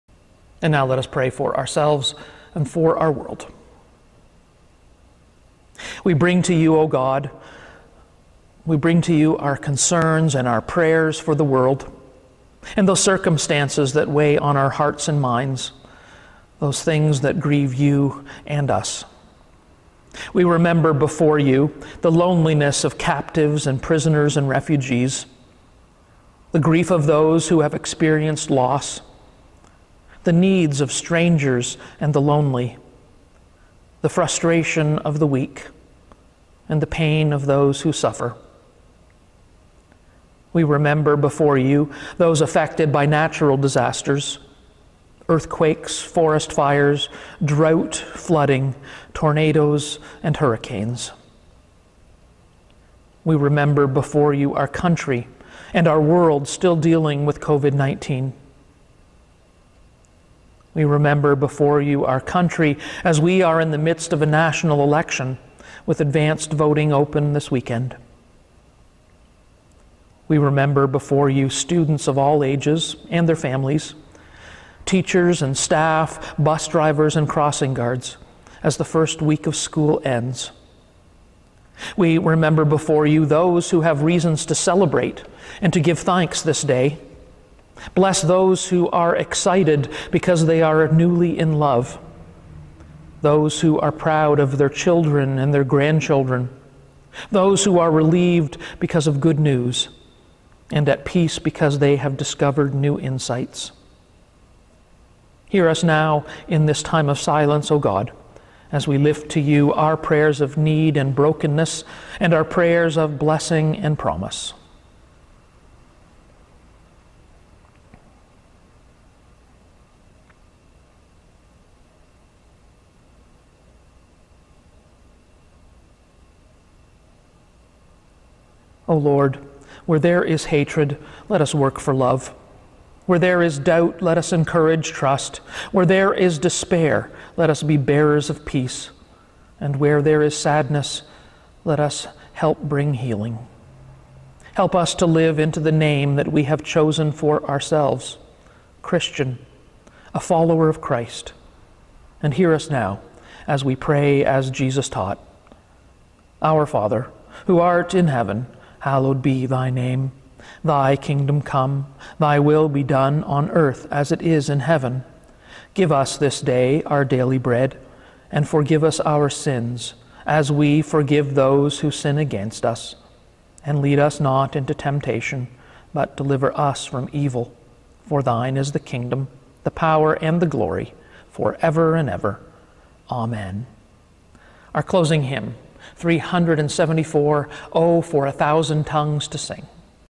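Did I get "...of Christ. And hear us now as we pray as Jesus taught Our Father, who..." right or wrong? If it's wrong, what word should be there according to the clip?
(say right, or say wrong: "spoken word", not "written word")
right.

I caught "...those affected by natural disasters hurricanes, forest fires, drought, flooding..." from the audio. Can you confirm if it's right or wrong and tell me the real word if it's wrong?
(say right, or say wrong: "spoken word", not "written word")
wrong: "earthquakes", not "hurricanes".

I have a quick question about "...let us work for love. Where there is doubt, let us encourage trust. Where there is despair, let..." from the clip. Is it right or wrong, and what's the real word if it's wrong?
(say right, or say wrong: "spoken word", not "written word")
right.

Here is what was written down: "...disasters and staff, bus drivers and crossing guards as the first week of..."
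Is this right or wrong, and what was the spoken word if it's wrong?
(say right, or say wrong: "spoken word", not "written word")
wrong: "teachers", not "disasters".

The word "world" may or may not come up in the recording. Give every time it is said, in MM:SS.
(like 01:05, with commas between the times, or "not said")
00:03, 00:11, 00:56.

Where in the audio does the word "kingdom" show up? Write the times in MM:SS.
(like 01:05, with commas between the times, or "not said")
02:40, 02:58.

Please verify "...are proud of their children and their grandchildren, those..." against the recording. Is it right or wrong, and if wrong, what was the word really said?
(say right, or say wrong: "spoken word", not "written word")
right.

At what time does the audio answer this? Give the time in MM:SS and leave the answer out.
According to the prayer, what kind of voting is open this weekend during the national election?
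01:05.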